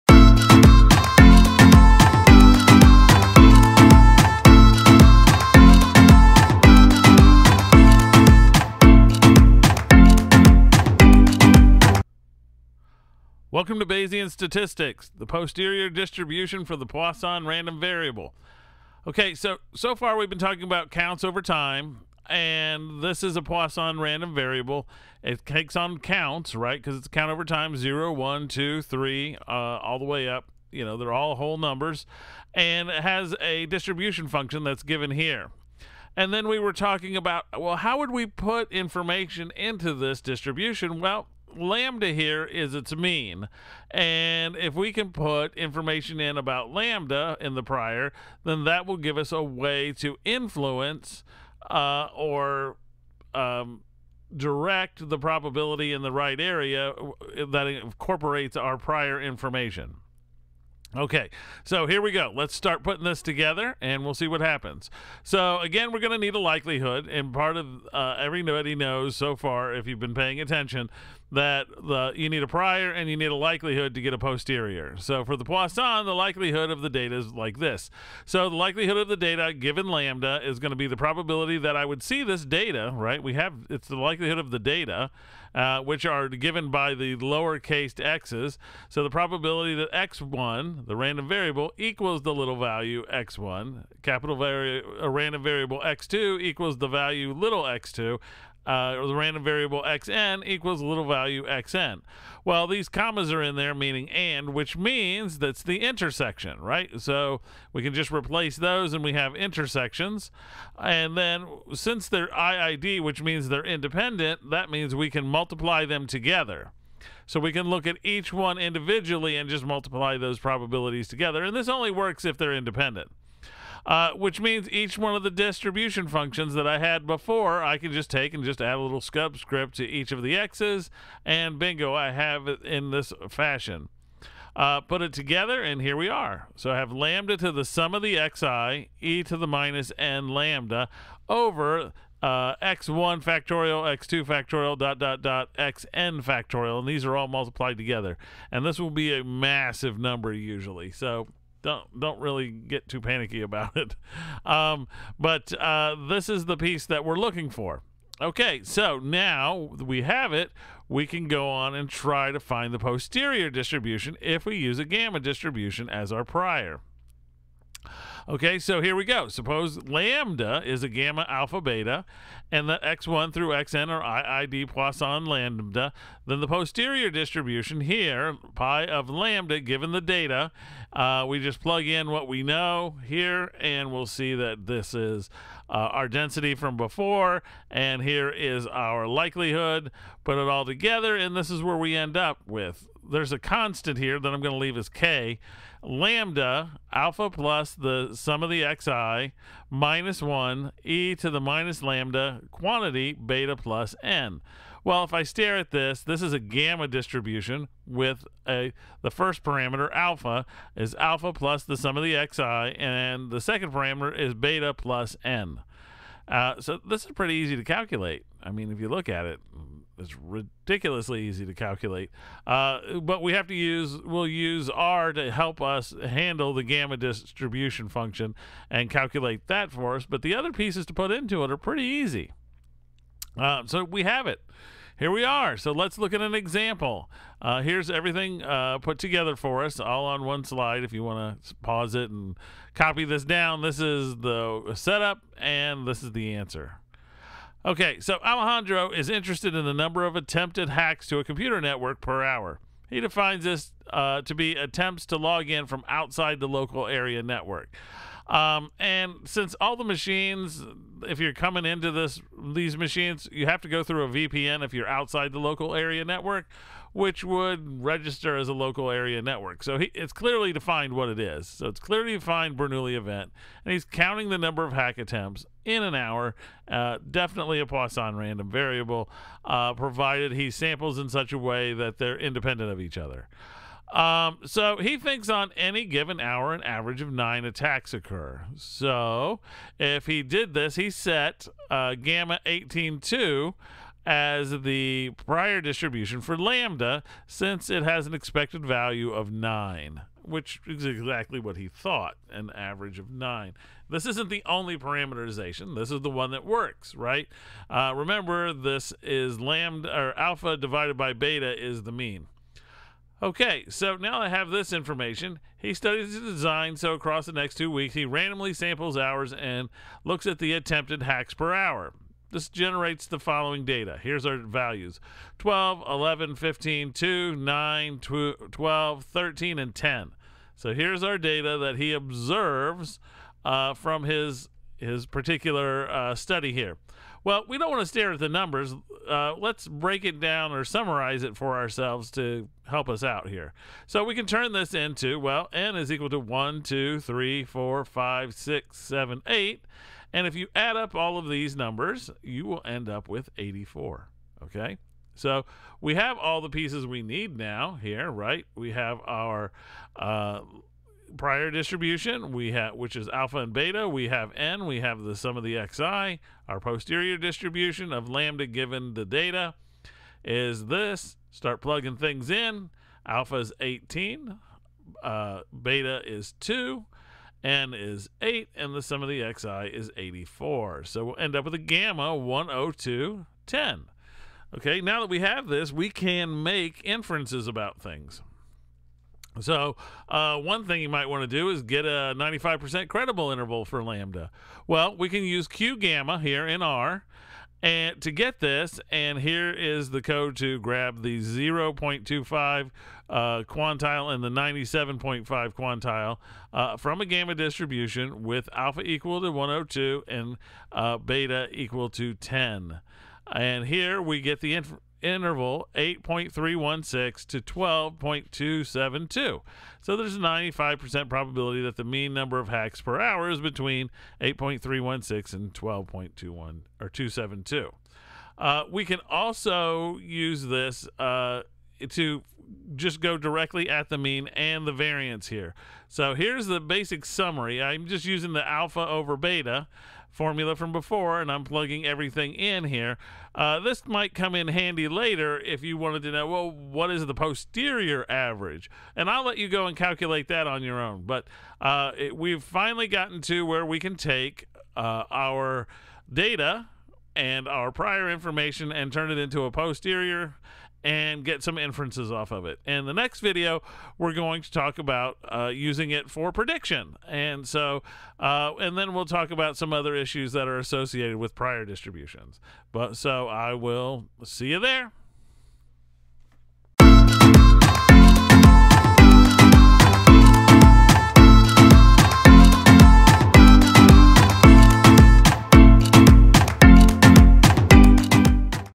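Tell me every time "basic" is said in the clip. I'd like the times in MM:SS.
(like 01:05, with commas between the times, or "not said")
07:16.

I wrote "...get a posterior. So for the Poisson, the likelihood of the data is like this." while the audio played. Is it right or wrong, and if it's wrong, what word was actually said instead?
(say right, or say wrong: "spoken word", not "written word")
right.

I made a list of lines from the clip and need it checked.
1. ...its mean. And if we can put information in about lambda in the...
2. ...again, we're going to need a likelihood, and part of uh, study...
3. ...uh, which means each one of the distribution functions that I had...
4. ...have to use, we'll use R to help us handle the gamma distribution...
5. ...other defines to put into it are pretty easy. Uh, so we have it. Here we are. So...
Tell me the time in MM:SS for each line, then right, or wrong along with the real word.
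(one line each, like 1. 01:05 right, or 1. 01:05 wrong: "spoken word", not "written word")
1. 00:42 right
2. 01:05 wrong: "everybody", not "study"
3. 02:03 right
4. 03:43 right
5. 03:50 wrong: "pieces", not "defines".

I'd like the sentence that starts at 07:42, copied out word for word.
And the next video, we're going to talk about uh, using it for prediction.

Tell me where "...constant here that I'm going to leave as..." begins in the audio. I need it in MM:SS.
03:13.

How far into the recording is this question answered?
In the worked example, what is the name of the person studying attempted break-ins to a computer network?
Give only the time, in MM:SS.
04:08.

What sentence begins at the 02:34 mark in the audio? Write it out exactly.
Um, but uh, this is the piece that we're looking for.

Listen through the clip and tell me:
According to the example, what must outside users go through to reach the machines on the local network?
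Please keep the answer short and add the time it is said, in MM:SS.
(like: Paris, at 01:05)
a VPN, at 04:24.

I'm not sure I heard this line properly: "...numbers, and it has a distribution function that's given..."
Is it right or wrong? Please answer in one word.
right.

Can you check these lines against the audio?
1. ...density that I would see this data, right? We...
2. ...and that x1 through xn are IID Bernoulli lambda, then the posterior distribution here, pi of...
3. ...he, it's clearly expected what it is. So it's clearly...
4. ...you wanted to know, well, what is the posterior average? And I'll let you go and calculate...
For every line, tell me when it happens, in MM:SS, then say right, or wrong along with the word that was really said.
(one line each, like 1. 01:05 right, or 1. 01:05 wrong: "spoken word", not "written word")
1. 01:20 wrong: "probability", not "density"
2. 02:52 wrong: "Poisson", not "Bernoulli"
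3. 04:29 wrong: "defined", not "expected"
4. 07:25 right.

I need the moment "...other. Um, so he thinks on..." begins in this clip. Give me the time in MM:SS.
04:42.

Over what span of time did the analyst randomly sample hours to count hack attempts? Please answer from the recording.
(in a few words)
two weeks.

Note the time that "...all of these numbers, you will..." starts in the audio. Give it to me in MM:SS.
05:50.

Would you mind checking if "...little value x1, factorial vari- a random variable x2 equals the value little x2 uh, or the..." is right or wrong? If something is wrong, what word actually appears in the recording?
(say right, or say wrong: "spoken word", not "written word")
wrong: "capital", not "factorial".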